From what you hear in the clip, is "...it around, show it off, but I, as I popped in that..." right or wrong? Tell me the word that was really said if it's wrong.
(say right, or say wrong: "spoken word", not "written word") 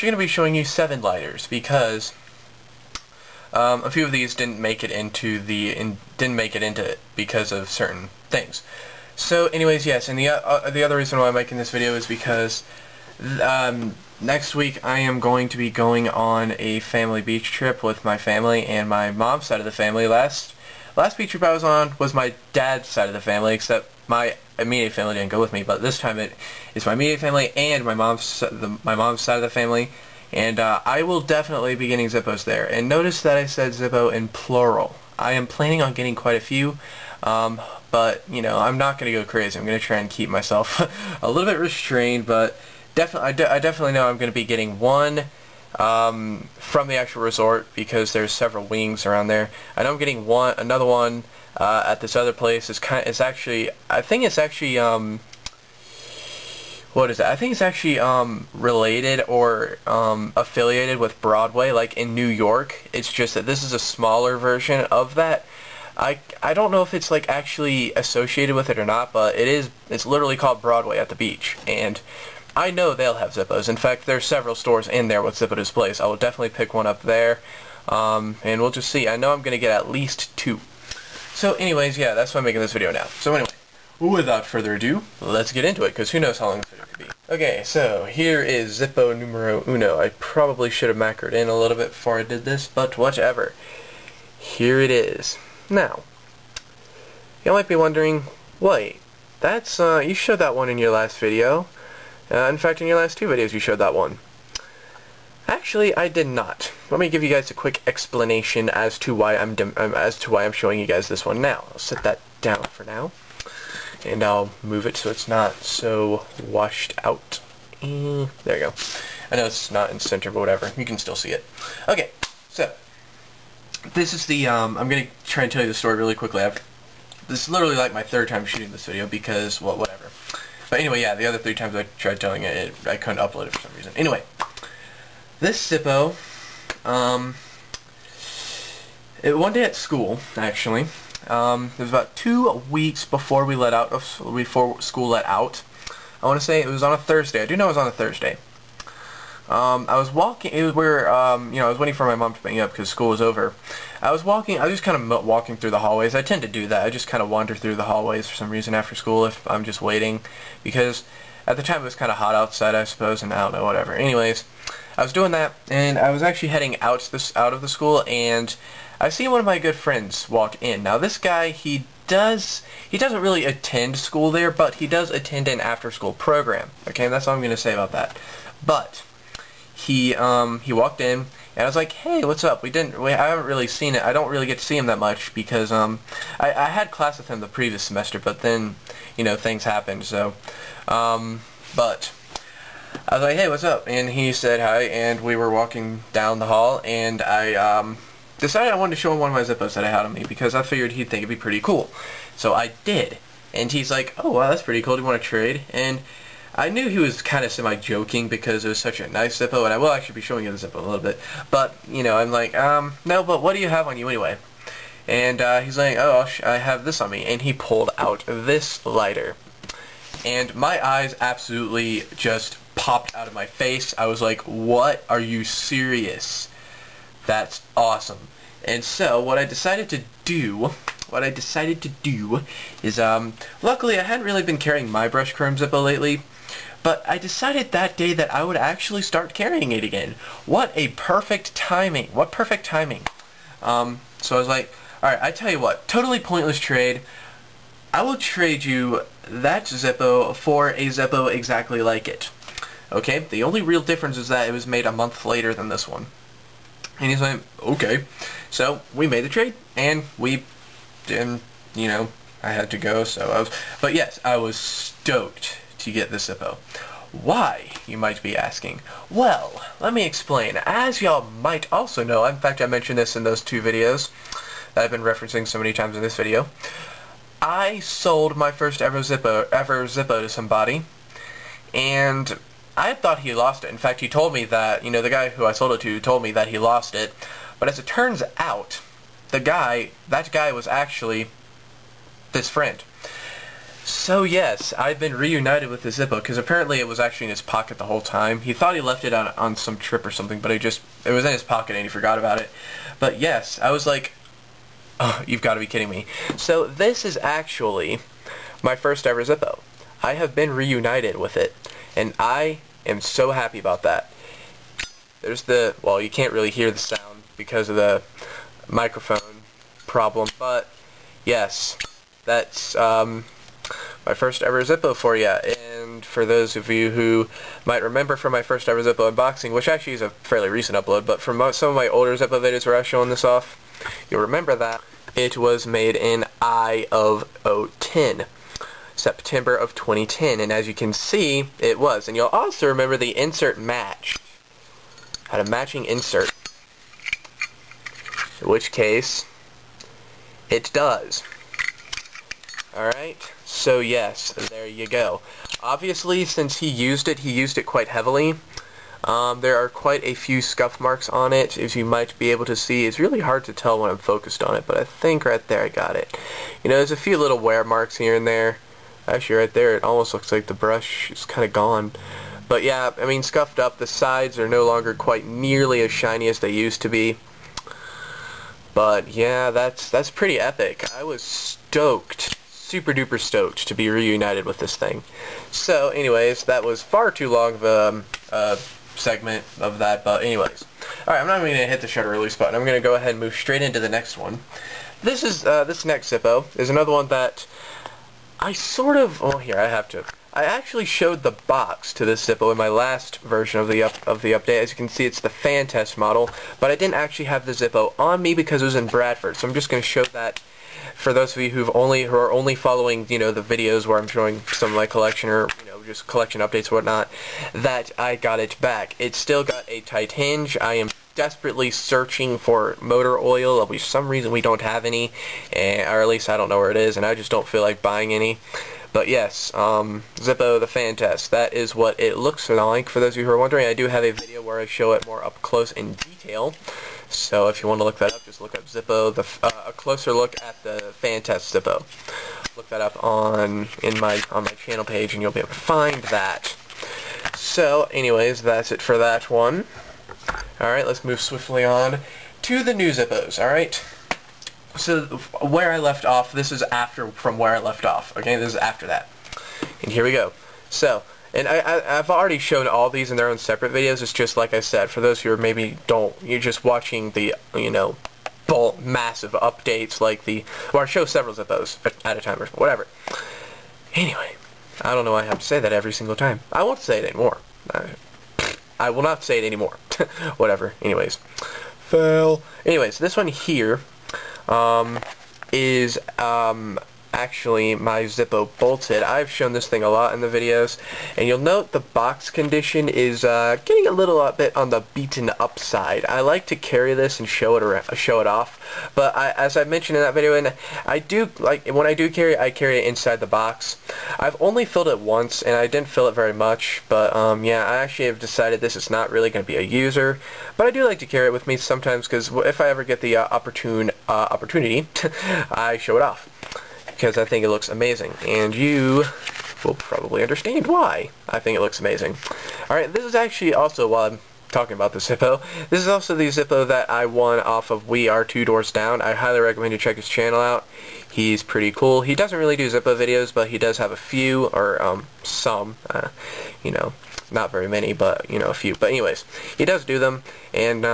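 wrong: "mentioned", not "popped".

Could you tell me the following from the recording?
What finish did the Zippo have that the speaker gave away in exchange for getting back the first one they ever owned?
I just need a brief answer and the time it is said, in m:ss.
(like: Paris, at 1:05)
brush chrome, at 3:55.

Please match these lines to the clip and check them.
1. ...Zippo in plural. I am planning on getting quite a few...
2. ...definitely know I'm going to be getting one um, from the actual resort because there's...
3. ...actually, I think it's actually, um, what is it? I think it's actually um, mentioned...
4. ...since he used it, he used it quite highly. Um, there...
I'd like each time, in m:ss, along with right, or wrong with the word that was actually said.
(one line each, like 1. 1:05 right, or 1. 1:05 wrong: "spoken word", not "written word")
1. 0:33 right
2. 0:43 right
3. 0:53 wrong: "related", not "mentioned"
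4. 5:56 wrong: "heavily", not "highly".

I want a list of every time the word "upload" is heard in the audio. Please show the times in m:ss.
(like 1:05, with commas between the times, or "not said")
2:13, 5:30.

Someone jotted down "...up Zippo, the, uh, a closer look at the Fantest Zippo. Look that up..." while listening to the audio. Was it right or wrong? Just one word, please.
right.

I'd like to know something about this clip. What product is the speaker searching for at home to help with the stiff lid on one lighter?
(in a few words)
motor oil.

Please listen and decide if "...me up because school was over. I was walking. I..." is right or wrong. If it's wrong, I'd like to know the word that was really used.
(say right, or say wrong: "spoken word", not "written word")
right.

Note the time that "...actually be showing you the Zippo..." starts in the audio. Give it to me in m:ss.
3:29.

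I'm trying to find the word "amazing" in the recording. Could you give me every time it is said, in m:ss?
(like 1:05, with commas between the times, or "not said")
8:37, 8:41.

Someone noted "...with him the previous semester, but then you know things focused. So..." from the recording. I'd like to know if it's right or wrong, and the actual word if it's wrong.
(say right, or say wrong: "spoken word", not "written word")
wrong: "happened", not "focused".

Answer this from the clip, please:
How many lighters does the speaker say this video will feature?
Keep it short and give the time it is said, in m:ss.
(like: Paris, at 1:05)
7, at 0:00.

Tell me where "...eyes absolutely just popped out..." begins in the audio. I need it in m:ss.
3:40.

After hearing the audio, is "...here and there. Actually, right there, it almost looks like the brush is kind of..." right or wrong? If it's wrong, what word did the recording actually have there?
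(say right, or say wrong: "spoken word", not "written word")
right.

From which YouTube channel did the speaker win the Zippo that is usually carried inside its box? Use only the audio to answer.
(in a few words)
We Are Two Doors Down.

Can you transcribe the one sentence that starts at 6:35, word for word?
This is, uh, this next Zippo is another one that I sort of, oh, here, I have to.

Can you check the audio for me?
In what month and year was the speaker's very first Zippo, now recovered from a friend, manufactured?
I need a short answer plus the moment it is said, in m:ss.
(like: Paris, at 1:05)
September 2010, at 5:38.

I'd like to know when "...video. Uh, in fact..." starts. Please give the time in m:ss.
1:41.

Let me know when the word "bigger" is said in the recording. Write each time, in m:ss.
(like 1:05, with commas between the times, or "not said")
not said.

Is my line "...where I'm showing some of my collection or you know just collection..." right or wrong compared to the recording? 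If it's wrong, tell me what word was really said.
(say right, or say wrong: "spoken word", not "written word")
right.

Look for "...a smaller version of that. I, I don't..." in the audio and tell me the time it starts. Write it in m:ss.
1:03.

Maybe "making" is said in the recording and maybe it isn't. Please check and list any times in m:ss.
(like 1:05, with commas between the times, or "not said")
0:11, 1:22.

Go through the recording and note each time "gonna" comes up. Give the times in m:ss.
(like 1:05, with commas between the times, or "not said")
2:04, 2:57.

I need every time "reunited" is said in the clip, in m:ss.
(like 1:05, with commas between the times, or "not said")
4:55, 5:10, 6:23.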